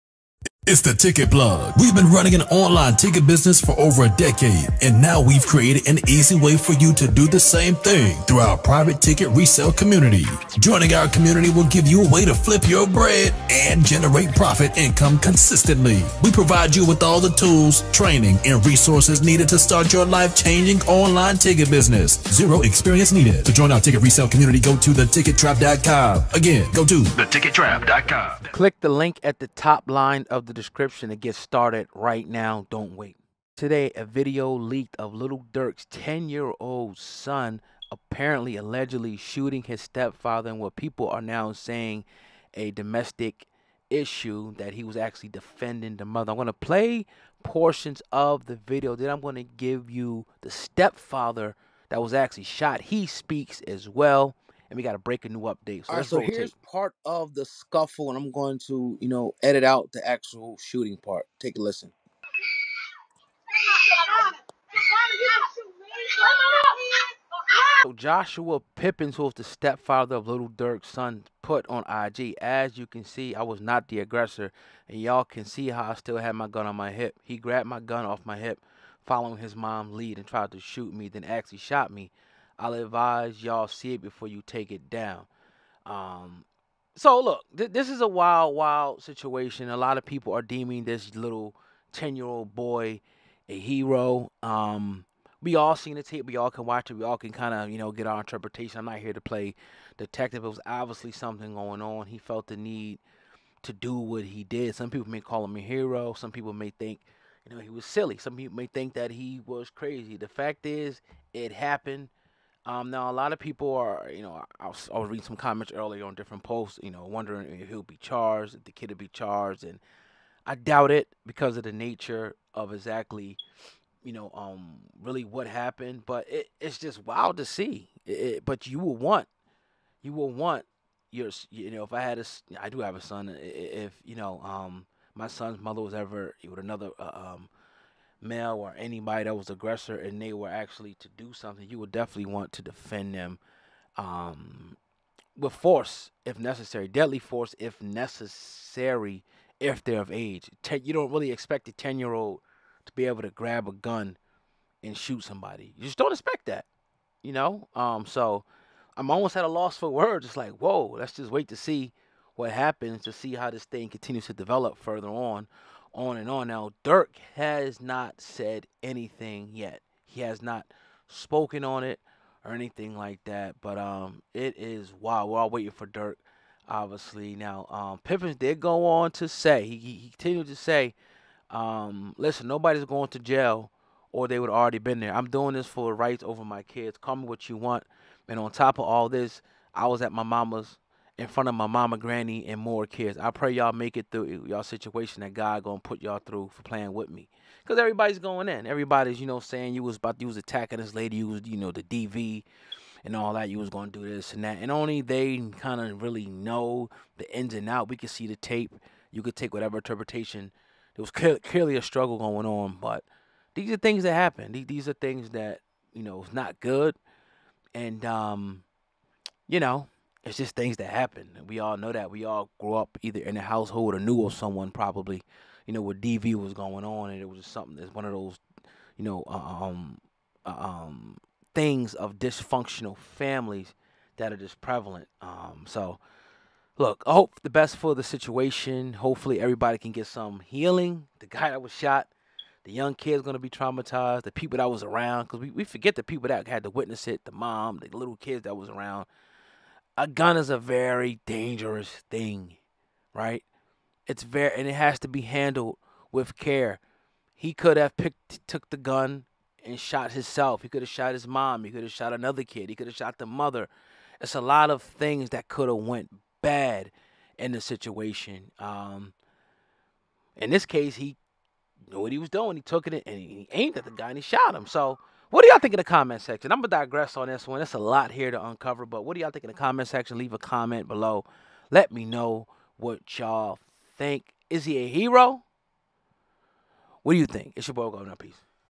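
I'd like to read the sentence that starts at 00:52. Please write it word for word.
He speaks as well and we got to break a new update.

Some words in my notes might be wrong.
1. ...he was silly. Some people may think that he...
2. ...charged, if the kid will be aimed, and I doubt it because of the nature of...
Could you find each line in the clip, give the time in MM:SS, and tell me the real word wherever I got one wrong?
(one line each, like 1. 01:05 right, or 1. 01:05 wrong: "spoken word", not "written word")
1. 01:47 right
2. 01:57 wrong: "charged", not "aimed".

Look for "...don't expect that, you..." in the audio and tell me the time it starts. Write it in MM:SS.
02:35.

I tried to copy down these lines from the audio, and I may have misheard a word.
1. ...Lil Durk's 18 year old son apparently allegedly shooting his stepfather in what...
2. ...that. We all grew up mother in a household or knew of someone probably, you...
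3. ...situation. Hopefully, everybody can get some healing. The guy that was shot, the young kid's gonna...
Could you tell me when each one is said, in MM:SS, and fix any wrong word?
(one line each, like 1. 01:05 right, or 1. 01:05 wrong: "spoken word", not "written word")
1. 00:35 wrong: "10", not "18"
2. 03:41 wrong: "either", not "mother"
3. 03:58 right.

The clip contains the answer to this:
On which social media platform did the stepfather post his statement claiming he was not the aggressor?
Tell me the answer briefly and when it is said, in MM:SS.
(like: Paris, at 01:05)
IG, at 01:11.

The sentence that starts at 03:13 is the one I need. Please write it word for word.
I pray y'all make it through y'all situation that God gonna put y'all through for playing with me.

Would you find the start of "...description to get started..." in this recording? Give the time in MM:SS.
00:30.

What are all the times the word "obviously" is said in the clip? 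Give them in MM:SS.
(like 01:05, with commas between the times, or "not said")
01:40, 02:56.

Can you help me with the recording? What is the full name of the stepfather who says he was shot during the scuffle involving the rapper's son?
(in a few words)
Joshua Pippins.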